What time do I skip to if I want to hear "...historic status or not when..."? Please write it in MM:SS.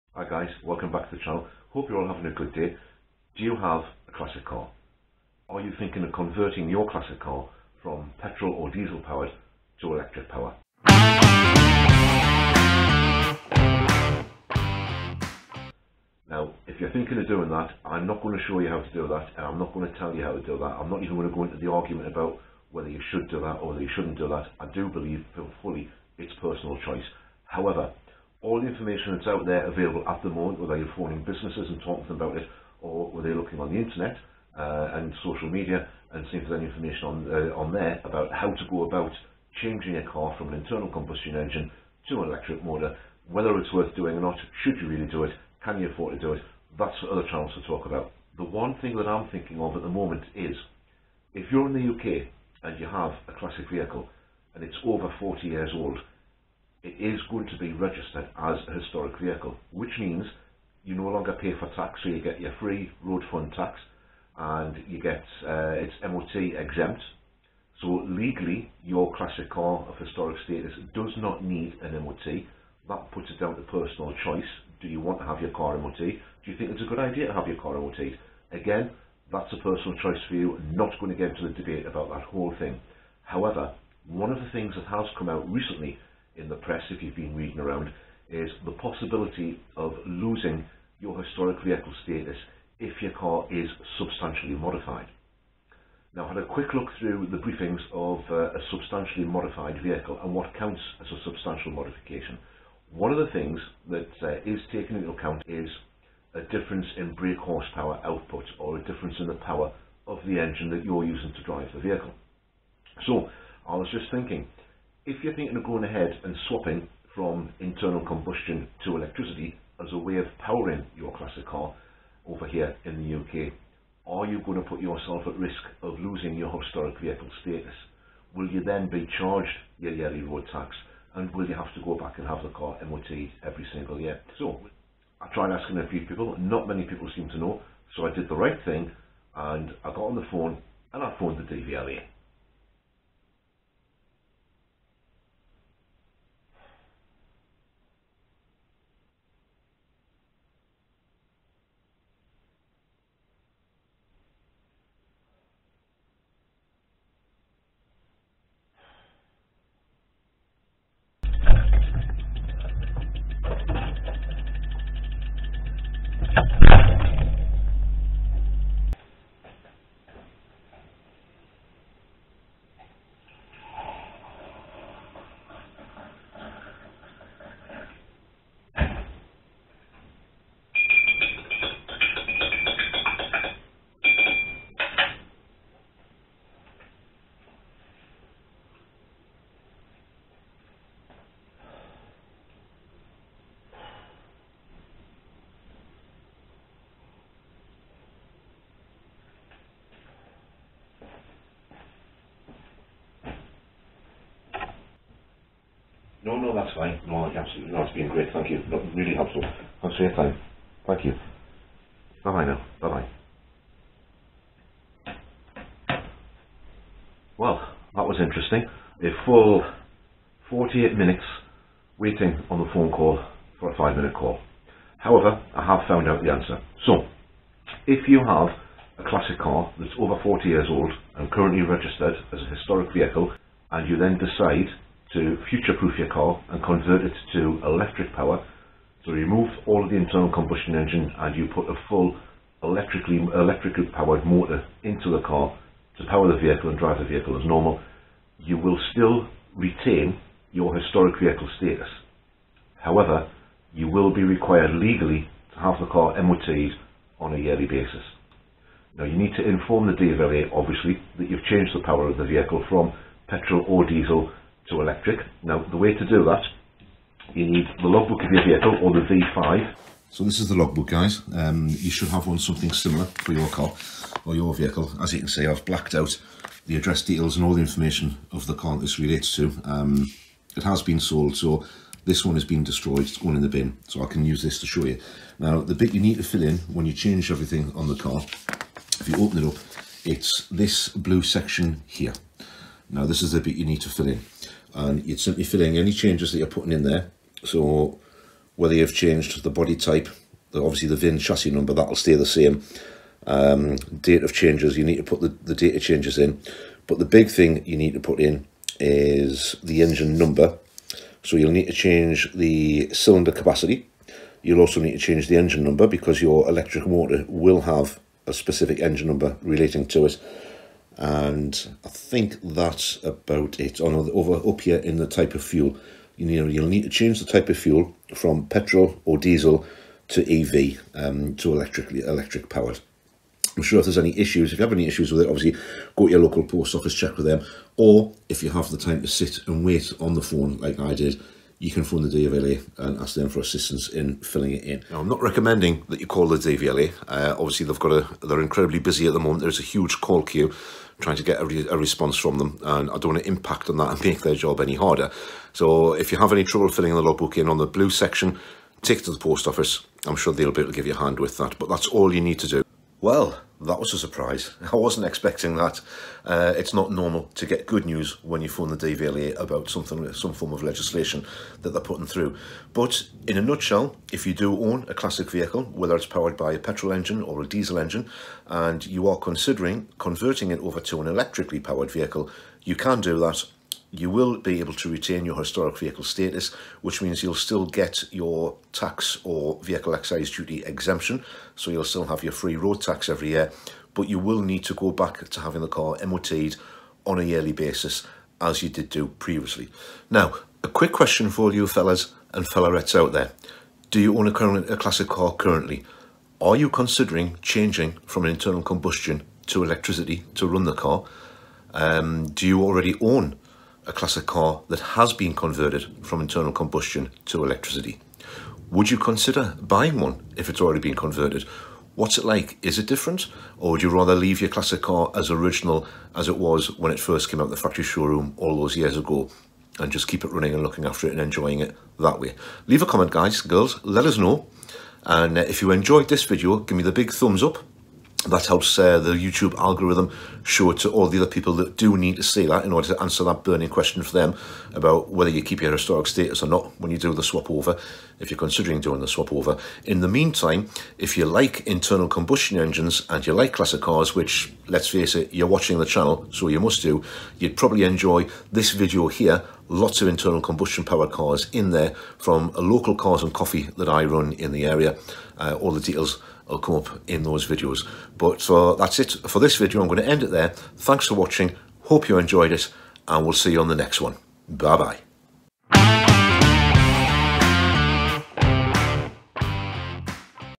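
07:25.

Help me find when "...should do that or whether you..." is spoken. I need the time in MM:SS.
00:23.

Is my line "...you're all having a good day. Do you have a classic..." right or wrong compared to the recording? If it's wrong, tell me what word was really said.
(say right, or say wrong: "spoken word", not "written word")
right.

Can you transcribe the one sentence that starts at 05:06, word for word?
But the big thing you need to put in is the engine number.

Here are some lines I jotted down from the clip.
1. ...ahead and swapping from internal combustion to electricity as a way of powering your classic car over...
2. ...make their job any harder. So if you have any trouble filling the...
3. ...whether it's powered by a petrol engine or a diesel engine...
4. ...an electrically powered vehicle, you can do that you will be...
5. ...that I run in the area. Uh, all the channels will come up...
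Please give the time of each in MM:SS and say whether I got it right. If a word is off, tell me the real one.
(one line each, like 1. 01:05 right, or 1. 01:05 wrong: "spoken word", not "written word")
1. 01:55 right
2. 05:54 right
3. 06:15 right
4. 06:21 right
5. 07:43 wrong: "details", not "channels".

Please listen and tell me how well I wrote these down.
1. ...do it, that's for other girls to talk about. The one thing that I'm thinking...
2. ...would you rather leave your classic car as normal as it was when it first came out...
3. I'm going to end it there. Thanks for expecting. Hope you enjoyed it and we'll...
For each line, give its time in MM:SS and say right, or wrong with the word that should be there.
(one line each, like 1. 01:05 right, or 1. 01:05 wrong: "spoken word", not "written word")
1. 00:46 wrong: "channels", not "girls"
2. 07:03 wrong: "original", not "normal"
3. 07:49 wrong: "watching", not "expecting".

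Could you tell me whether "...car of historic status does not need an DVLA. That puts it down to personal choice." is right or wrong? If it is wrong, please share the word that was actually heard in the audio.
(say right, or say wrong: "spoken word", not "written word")
wrong: "MOT", not "DVLA".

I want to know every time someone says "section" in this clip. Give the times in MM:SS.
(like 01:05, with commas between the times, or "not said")
04:51, 05:57.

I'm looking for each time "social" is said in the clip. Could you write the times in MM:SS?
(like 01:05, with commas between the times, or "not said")
00:35.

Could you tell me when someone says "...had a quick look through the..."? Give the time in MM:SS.
01:36.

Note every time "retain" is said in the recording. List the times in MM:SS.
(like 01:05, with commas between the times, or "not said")
04:09, 06:24.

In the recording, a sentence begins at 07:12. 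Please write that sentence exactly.
Leave a comment, guys, girls, let us know.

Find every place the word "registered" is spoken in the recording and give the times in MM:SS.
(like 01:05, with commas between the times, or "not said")
00:57, 03:51.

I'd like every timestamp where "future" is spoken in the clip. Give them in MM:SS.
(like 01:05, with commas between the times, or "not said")
03:55.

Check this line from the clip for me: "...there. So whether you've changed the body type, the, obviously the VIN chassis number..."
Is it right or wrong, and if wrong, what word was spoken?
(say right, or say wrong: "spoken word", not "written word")
right.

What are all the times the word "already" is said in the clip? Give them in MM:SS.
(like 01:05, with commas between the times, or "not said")
06:52, 07:00.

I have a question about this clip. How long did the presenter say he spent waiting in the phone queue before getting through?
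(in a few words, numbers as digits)
48 minutes.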